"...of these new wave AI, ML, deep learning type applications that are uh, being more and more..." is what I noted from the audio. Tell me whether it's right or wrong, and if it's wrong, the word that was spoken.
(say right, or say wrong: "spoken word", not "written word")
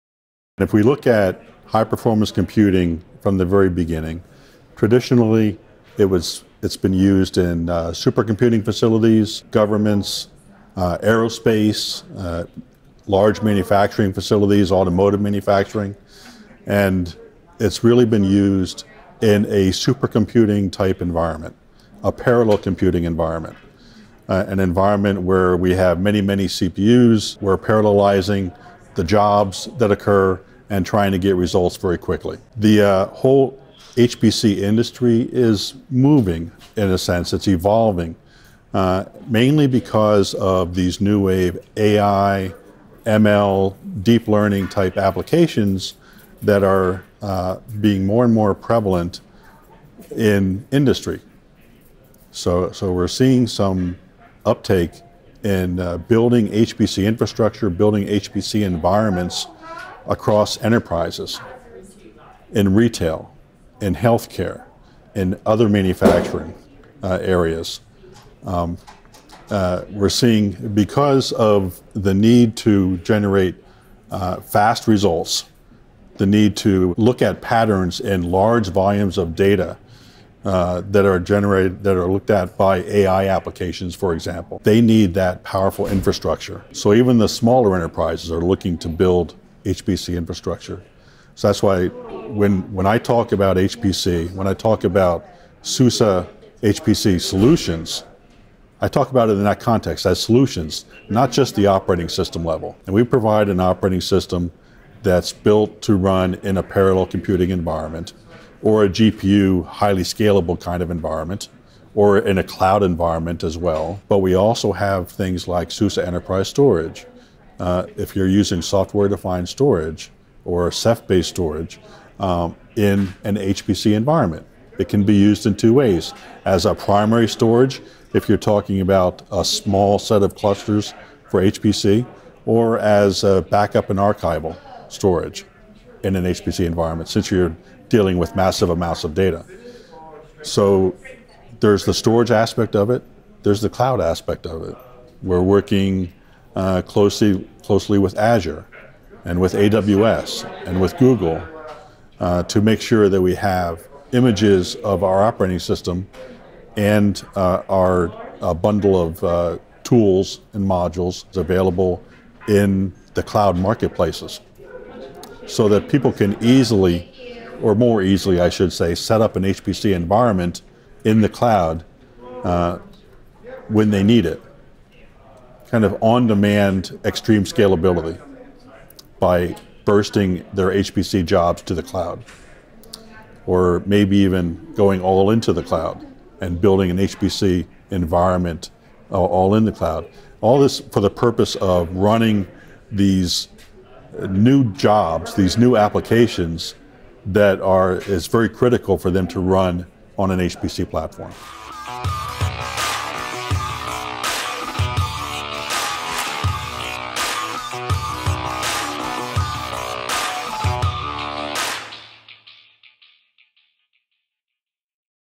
right.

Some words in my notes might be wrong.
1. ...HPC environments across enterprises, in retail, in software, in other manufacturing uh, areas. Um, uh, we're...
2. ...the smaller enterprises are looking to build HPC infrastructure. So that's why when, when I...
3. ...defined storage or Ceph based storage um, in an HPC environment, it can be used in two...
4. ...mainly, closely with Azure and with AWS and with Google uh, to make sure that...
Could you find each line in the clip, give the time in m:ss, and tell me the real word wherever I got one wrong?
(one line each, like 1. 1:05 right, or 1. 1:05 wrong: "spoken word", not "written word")
1. 0:58 wrong: "healthcare", not "software"
2. 1:27 right
3. 1:59 right
4. 2:26 wrong: "closely", not "mainly".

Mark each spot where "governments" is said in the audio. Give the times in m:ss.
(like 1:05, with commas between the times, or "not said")
0:09.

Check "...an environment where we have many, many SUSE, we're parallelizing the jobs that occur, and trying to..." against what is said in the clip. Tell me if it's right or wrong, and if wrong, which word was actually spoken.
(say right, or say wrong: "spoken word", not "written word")
wrong: "CPUs", not "SUSE".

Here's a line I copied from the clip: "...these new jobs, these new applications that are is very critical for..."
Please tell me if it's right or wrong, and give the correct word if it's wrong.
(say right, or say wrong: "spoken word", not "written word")
right.